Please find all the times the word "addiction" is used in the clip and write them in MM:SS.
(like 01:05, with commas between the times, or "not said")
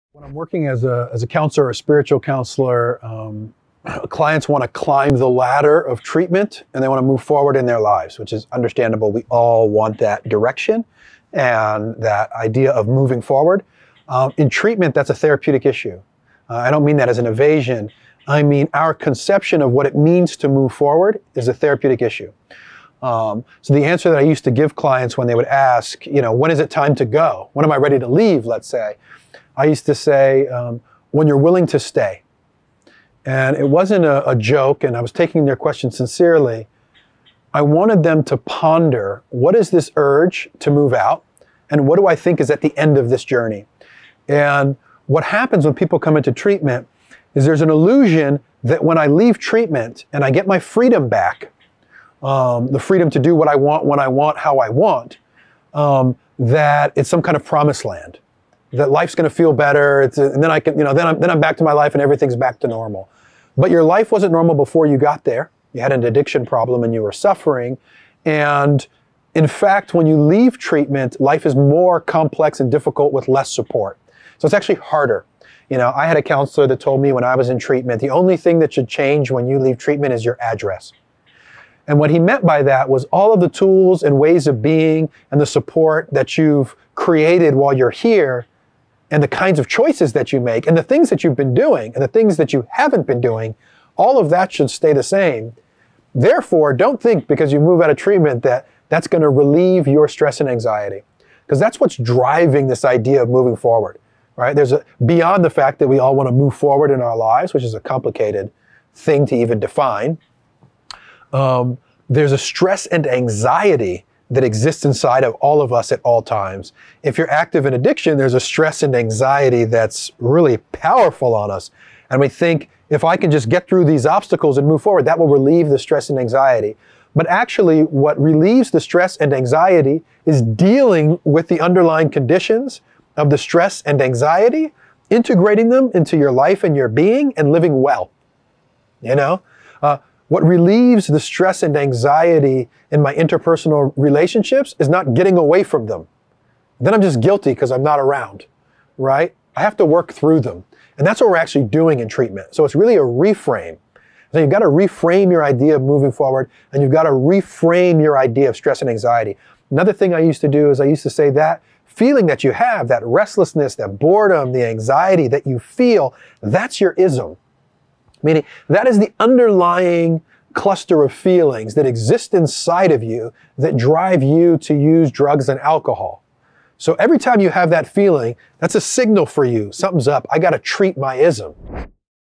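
01:06, 01:57.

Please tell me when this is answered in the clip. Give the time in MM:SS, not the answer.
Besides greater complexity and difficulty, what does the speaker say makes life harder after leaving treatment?
01:13.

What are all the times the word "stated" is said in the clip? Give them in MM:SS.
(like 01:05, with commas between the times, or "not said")
not said.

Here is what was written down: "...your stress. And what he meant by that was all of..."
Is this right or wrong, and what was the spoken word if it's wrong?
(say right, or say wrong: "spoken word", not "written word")
wrong: "address", not "stress".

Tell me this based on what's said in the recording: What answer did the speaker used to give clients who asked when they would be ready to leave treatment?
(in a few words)
When you're willing to stay.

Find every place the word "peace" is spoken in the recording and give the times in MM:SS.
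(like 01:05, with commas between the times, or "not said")
not said.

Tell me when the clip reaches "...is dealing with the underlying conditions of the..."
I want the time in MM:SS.
02:10.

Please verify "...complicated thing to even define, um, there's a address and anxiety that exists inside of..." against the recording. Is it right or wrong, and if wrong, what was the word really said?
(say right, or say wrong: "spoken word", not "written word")
wrong: "stress", not "address".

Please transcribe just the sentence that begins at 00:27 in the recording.
When am I ready to leave?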